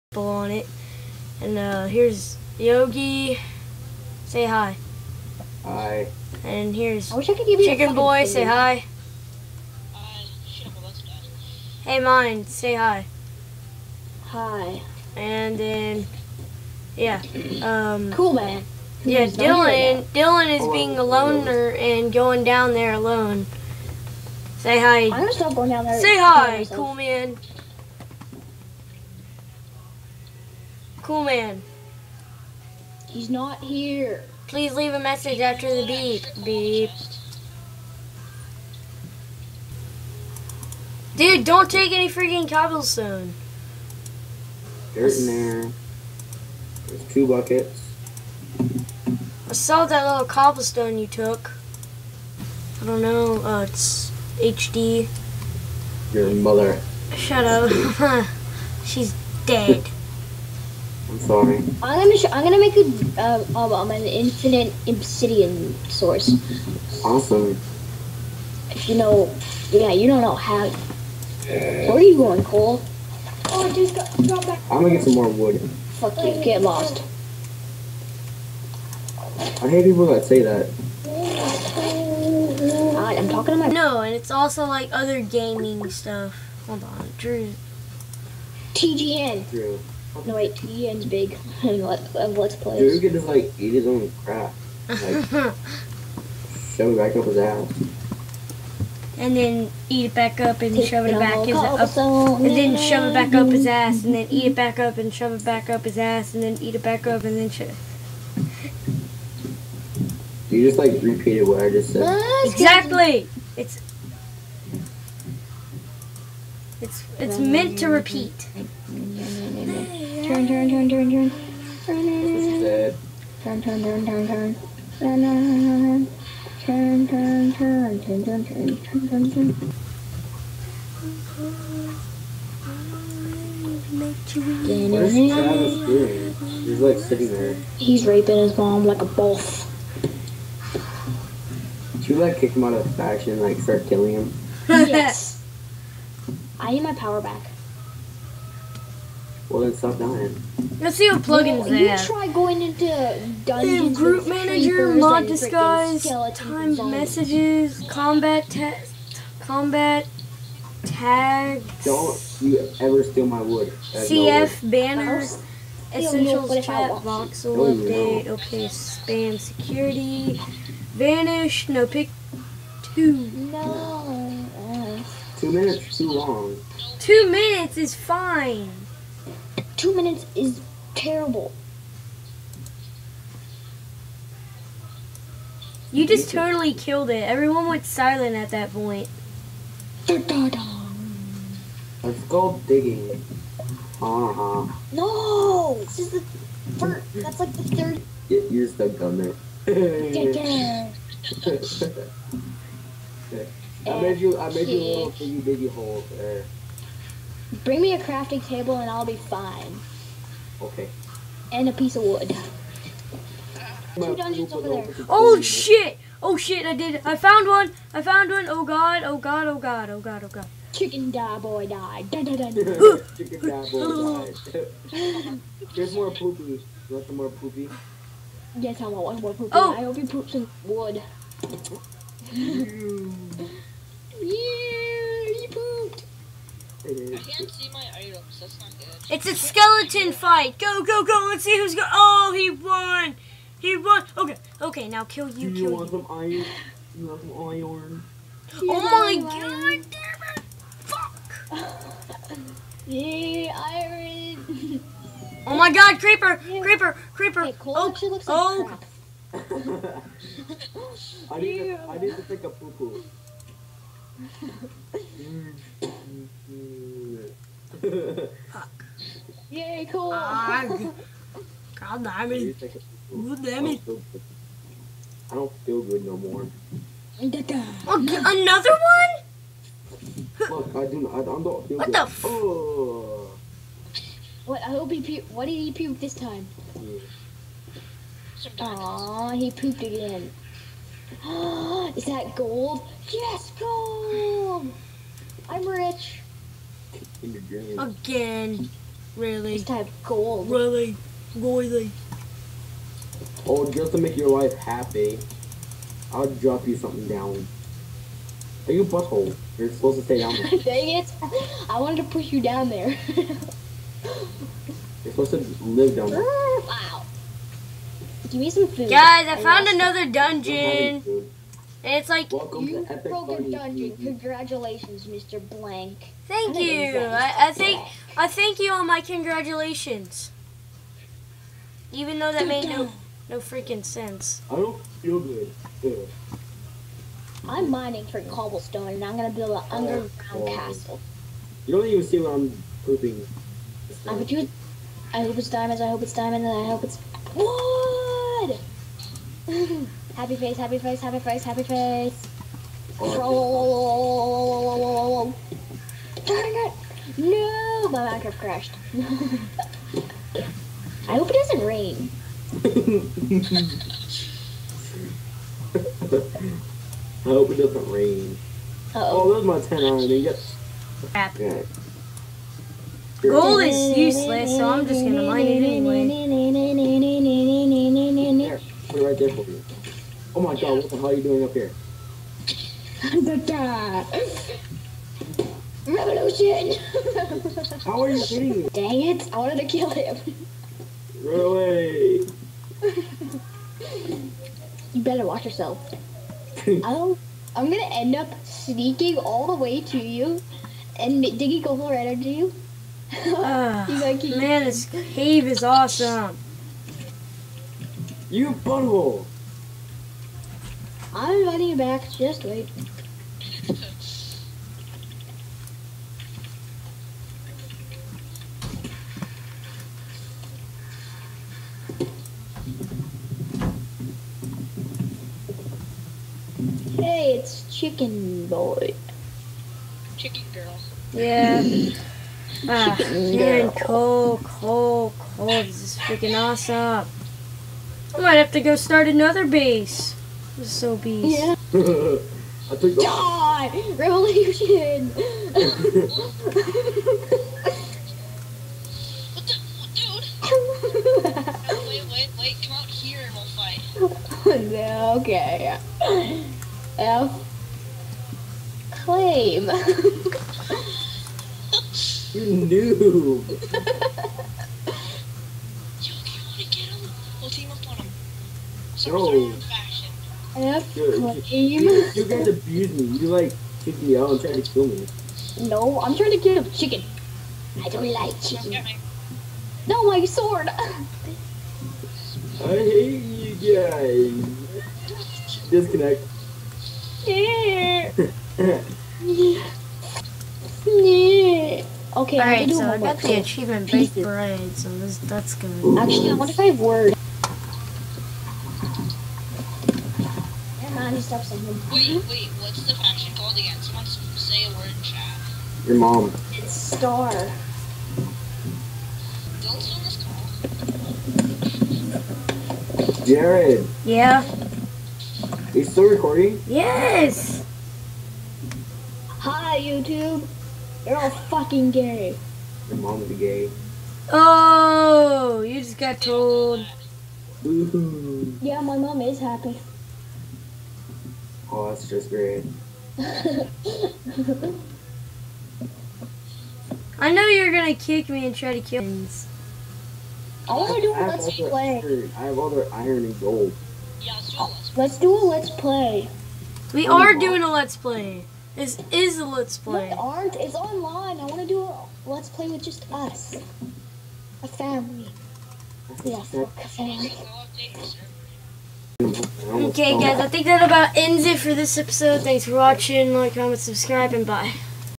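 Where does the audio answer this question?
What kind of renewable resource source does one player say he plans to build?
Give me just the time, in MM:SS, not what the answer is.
01:04.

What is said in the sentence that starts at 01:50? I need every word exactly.
You just like repeated what I just said.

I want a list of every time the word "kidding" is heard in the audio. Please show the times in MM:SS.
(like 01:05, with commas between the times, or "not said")
06:28.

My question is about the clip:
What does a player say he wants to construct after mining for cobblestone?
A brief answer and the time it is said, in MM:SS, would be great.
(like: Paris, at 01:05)
underground castle, at 05:39.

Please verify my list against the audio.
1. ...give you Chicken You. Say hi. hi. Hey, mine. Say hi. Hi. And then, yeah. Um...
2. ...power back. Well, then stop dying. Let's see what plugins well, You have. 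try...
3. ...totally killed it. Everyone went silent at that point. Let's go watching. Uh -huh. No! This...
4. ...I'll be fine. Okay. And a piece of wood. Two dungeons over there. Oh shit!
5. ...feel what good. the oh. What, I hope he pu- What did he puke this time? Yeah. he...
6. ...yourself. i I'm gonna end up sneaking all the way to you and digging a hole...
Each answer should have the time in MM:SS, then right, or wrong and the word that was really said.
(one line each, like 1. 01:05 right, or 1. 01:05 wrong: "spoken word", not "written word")
1. 00:07 wrong: "Boy", not "You"
2. 02:26 right
3. 03:06 wrong: "digging", not "watching"
4. 03:28 right
5. 04:41 right
6. 06:35 right.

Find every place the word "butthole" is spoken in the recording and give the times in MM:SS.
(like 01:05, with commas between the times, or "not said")
05:08, 06:48.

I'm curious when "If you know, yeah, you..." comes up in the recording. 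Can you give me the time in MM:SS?
01:08.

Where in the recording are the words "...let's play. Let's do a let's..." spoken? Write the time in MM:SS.
09:05.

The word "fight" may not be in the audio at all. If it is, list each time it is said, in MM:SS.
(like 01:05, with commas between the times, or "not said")
04:00, 07:33.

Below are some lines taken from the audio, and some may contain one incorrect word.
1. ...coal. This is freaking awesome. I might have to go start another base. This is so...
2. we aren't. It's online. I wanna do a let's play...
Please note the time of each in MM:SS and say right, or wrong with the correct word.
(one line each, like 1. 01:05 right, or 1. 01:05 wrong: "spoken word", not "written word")
1. 07:15 right
2. 09:10 right.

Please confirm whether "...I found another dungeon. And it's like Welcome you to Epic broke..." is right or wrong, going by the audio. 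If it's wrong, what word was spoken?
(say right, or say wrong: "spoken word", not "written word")
right.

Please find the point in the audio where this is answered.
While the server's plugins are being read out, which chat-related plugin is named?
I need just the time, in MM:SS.
02:45.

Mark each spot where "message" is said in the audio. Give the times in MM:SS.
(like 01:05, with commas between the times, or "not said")
00:34, 02:36.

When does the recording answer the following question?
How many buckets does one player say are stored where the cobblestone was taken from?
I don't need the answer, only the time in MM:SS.
00:47.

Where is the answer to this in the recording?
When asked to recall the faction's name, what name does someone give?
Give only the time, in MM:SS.
08:26.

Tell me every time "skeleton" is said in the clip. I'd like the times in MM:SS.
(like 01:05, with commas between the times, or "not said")
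03:59.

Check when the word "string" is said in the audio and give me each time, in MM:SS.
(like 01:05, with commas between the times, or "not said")
not said.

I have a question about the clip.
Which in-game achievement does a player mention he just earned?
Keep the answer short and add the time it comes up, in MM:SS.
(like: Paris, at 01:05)
baked bread, at 08:13.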